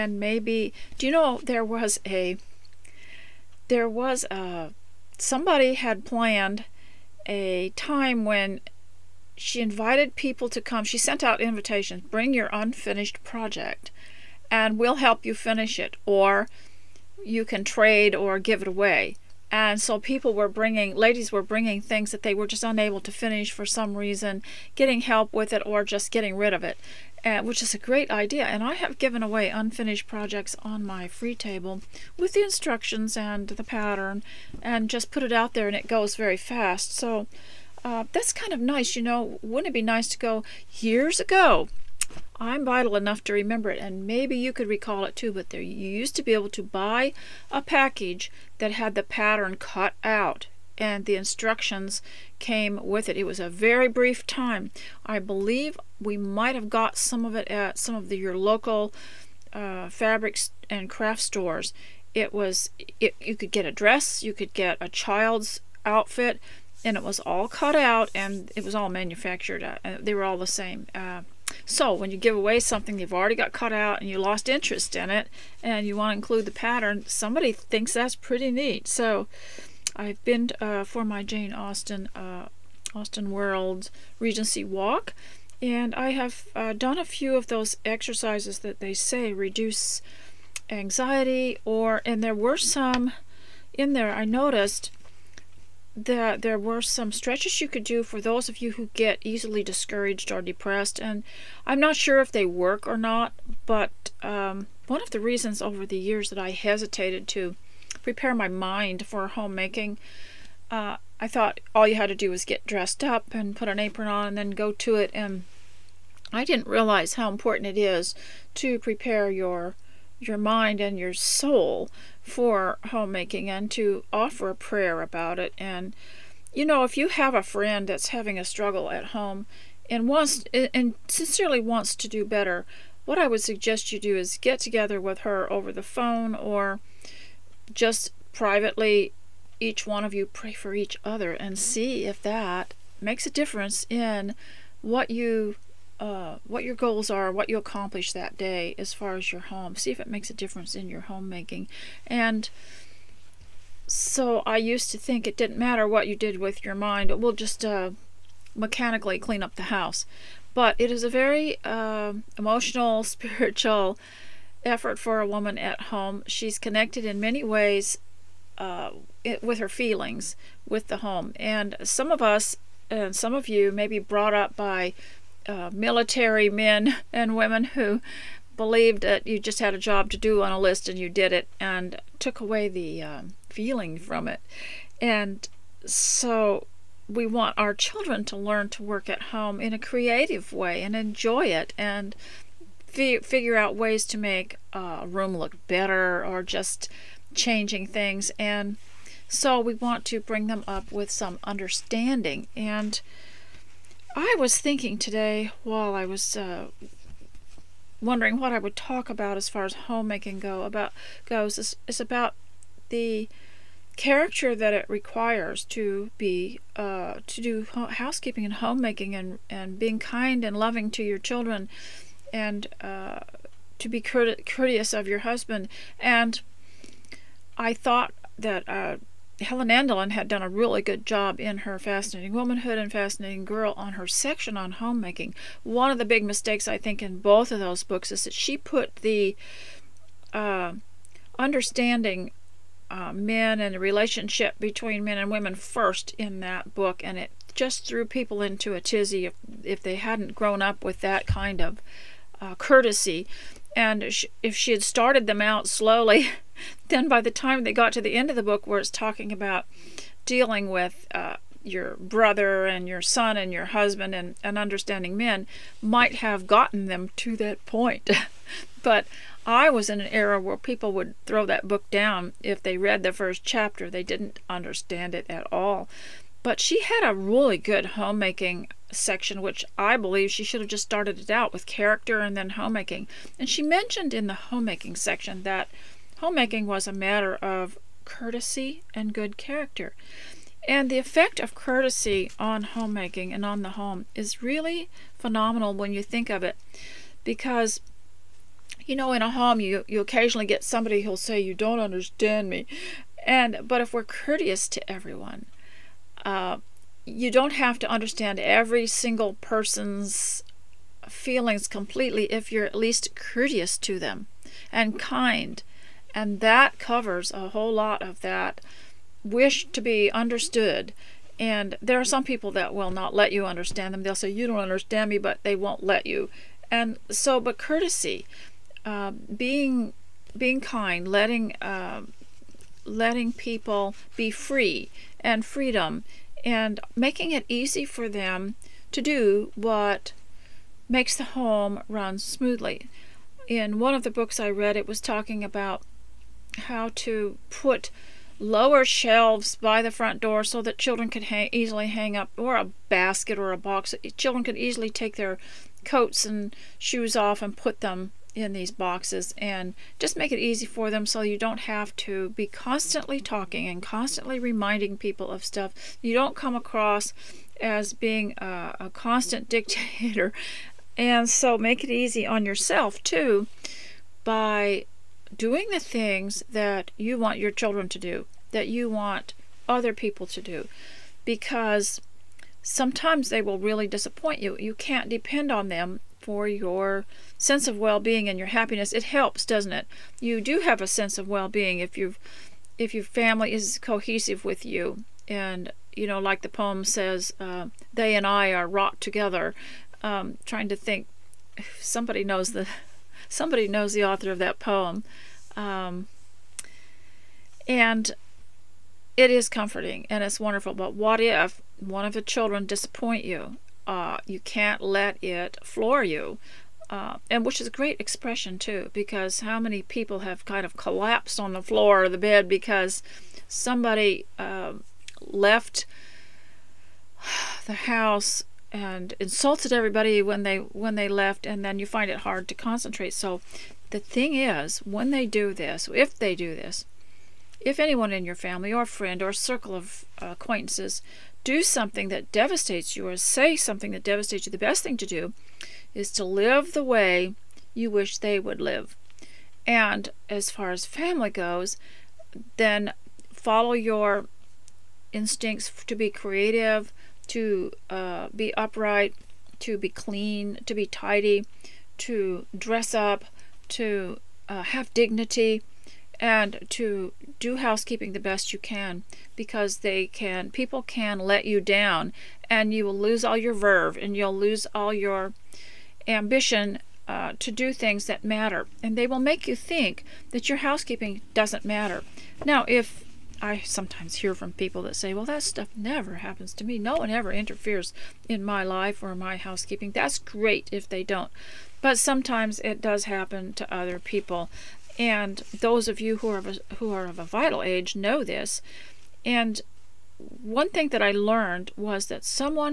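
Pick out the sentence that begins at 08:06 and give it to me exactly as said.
No one ever interferes in my life or my housekeeping.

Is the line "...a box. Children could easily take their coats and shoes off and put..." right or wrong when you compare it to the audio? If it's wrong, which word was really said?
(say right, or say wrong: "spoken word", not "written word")
right.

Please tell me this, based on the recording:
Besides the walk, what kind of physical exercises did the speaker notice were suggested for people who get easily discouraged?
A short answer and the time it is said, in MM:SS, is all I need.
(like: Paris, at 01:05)
stretches, at 01:37.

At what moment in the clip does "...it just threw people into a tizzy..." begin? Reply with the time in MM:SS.
04:07.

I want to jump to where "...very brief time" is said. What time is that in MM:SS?
00:53.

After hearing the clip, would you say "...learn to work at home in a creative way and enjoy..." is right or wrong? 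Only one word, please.
right.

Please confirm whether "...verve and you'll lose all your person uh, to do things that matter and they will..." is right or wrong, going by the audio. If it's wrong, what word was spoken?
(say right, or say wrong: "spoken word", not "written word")
wrong: "ambition", not "person".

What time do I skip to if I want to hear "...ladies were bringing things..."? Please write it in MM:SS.
00:20.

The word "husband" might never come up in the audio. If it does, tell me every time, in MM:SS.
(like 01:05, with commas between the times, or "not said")
03:45, 04:23.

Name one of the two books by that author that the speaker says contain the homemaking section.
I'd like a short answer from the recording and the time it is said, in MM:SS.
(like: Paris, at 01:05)
Fascinating Womanhood, at 03:51.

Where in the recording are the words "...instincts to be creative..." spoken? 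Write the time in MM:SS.
07:35.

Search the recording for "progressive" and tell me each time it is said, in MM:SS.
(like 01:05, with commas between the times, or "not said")
not said.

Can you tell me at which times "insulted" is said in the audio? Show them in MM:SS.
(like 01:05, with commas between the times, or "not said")
07:09.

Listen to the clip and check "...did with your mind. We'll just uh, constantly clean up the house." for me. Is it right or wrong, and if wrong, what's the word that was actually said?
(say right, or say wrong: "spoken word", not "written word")
wrong: "mechanically", not "constantly".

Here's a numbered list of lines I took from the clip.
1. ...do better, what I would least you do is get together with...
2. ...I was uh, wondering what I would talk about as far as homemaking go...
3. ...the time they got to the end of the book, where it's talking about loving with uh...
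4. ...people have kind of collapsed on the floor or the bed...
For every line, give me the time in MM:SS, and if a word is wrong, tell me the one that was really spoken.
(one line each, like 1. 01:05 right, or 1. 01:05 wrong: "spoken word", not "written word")
1. 02:12 wrong: "suggest", not "least"
2. 03:25 right
3. 04:17 wrong: "dealing", not "loving"
4. 06:59 right.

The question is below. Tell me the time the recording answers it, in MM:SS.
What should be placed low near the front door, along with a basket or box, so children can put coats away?
05:48.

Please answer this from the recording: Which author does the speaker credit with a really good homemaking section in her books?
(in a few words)
Helen Andelin.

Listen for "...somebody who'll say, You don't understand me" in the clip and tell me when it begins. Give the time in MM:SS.
05:00.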